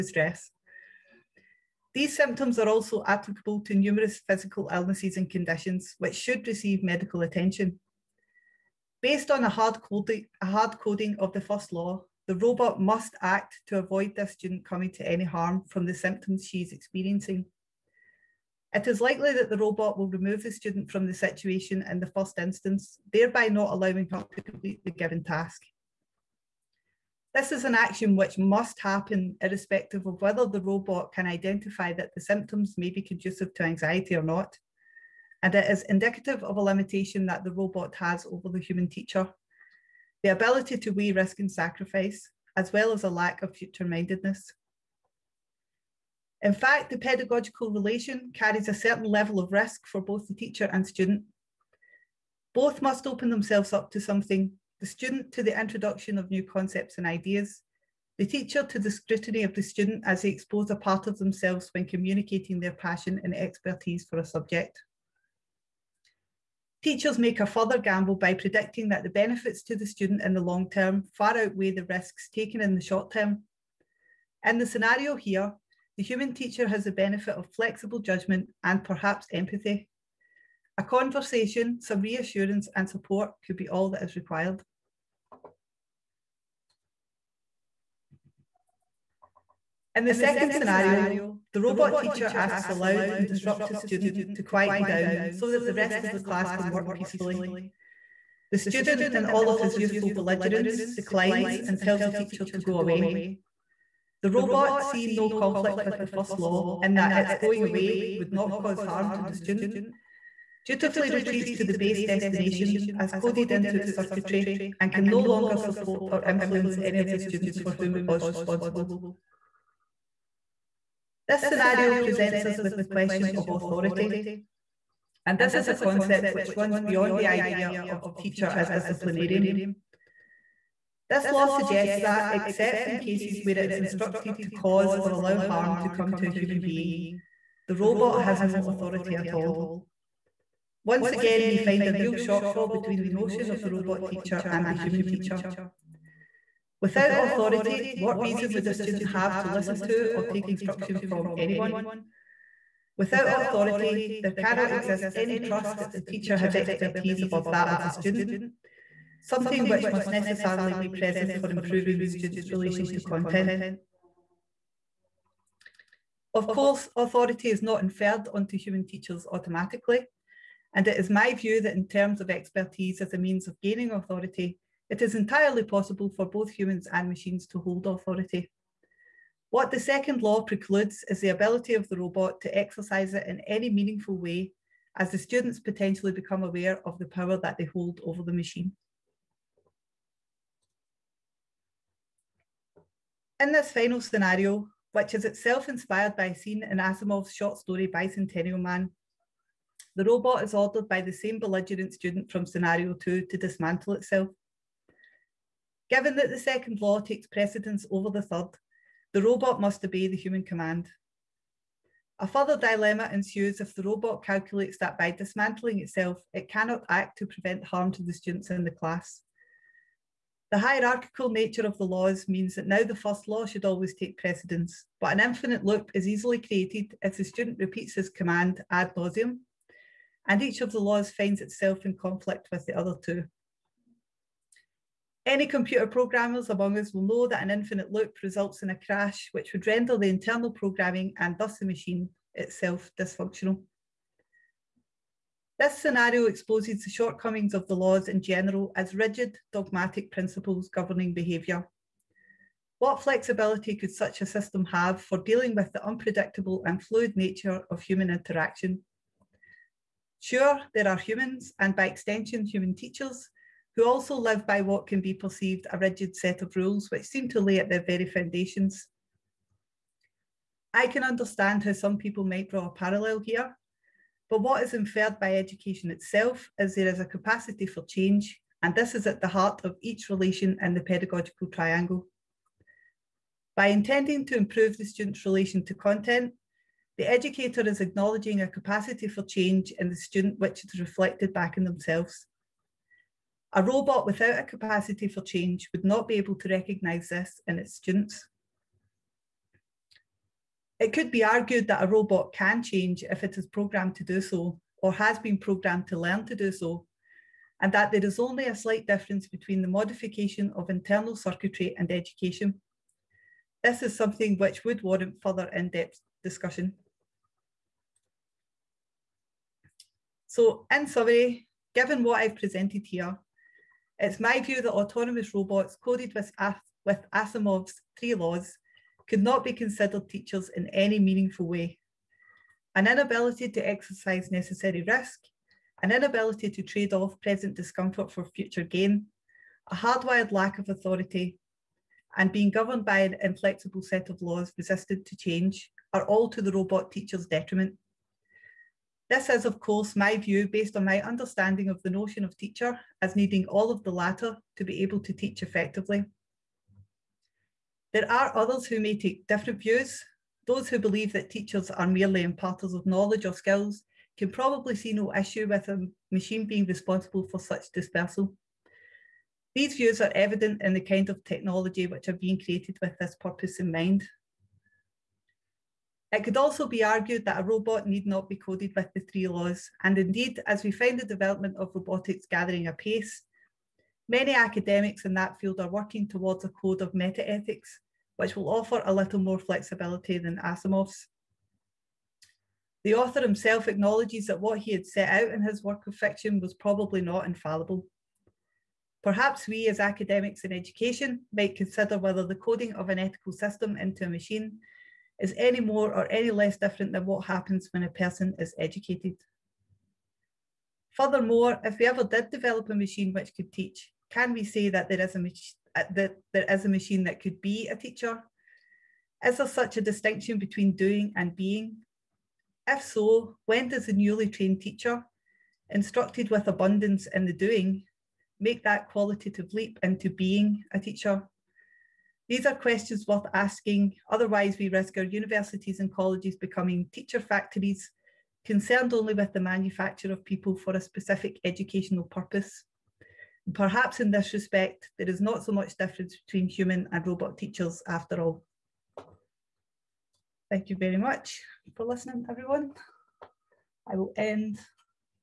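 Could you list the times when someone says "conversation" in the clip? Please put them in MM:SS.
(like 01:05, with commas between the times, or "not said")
01:20.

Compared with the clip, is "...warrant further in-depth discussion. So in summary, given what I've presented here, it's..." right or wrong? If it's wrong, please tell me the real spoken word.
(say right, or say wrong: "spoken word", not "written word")
right.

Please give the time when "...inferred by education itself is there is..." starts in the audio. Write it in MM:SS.
04:34.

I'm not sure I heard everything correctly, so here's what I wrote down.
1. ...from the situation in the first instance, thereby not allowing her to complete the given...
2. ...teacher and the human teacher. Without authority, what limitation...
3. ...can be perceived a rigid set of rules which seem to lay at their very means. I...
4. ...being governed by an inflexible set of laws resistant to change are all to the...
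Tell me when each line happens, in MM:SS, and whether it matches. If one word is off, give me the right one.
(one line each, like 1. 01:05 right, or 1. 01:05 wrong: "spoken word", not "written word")
1. 00:20 right
2. 02:24 wrong: "reason", not "limitation"
3. 04:24 wrong: "foundations", not "means"
4. 05:42 right.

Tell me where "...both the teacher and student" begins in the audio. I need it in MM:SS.
00:50.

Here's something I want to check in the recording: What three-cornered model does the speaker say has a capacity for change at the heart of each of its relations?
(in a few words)
pedagogical triangle.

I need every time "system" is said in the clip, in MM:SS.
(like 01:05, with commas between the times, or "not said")
04:14, 06:43.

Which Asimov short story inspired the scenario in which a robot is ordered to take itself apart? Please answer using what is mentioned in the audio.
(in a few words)
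Bicentennial Man.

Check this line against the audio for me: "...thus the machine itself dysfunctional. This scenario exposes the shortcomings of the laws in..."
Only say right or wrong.
right.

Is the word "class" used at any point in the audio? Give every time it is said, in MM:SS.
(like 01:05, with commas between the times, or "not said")
01:36, 03:38.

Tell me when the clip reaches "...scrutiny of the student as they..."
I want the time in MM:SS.
00:58.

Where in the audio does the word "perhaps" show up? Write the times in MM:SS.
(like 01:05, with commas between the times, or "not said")
01:18, 06:39, 07:23.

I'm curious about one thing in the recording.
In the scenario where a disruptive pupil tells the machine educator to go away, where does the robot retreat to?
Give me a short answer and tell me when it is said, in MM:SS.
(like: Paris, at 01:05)
base destination, at 01:51.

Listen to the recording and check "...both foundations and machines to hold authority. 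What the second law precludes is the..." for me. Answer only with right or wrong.
wrong.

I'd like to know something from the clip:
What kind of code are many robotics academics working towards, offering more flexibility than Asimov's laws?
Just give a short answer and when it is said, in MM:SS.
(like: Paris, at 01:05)
a code of metaethics, at 06:26.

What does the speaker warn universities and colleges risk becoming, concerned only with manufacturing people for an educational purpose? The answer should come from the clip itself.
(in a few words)
teacher factories.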